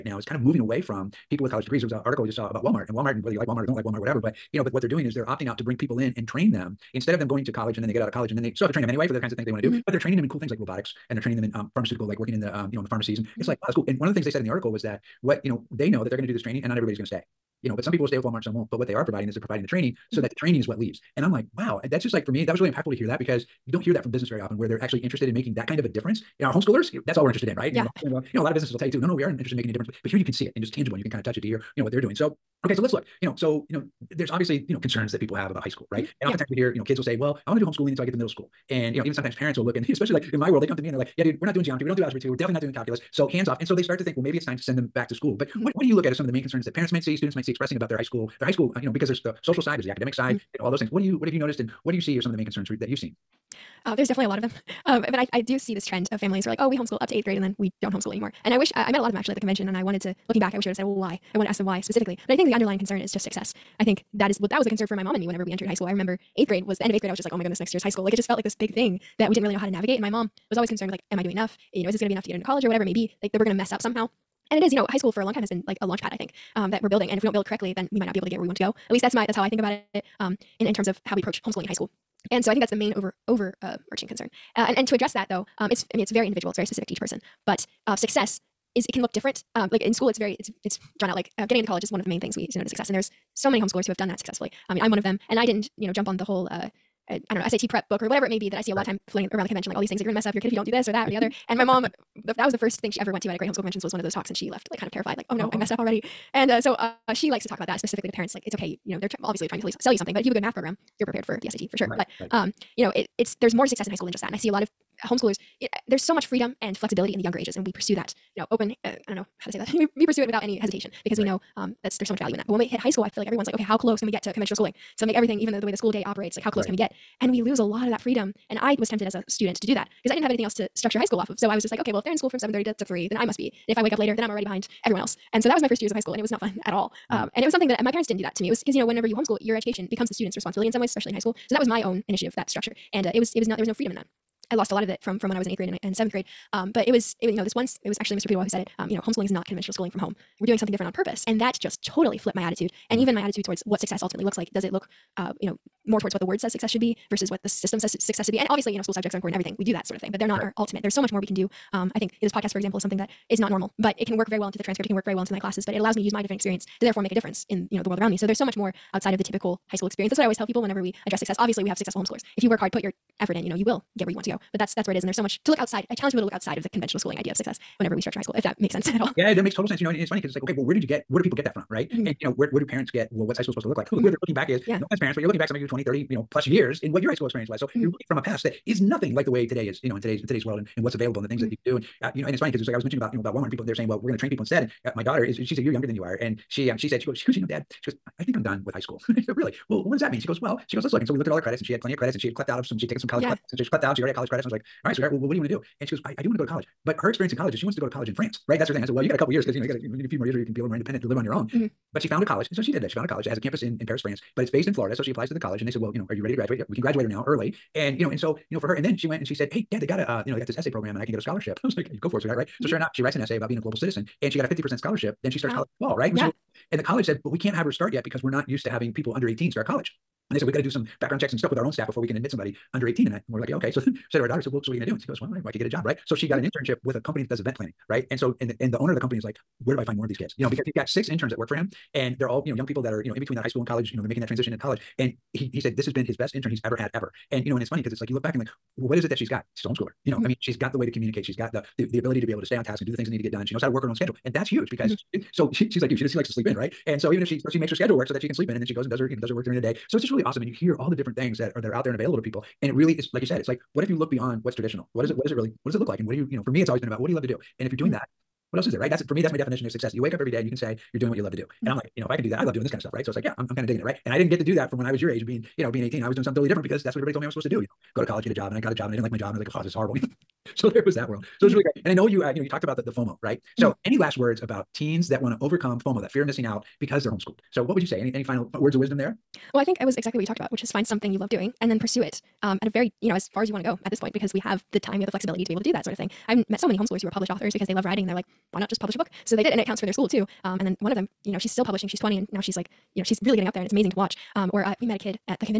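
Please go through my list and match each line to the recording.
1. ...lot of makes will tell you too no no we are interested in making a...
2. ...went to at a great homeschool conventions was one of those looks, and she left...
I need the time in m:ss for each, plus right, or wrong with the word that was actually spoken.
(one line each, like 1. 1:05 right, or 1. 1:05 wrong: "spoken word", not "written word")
1. 0:28 wrong: "businesses", not "makes"
2. 1:43 wrong: "talks", not "looks".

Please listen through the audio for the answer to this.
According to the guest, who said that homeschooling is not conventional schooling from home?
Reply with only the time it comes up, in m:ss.
2:28.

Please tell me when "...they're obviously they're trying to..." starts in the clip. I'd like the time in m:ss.
1:48.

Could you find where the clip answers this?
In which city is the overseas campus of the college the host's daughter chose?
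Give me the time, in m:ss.
3:33.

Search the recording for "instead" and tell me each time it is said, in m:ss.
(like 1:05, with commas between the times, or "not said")
0:06, 3:14.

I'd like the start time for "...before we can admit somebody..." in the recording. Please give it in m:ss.
3:51.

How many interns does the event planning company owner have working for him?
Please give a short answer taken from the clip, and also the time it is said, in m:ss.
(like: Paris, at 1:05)
6, at 4:00.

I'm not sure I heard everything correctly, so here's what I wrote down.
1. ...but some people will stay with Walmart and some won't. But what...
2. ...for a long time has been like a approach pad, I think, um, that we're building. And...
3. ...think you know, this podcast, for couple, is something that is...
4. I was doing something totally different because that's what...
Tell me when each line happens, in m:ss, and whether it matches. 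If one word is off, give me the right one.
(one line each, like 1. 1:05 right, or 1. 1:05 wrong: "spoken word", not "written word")
1. 0:17 right
2. 1:15 wrong: "launch", not "approach"
3. 2:41 wrong: "example", not "couple"
4. 4:36 right.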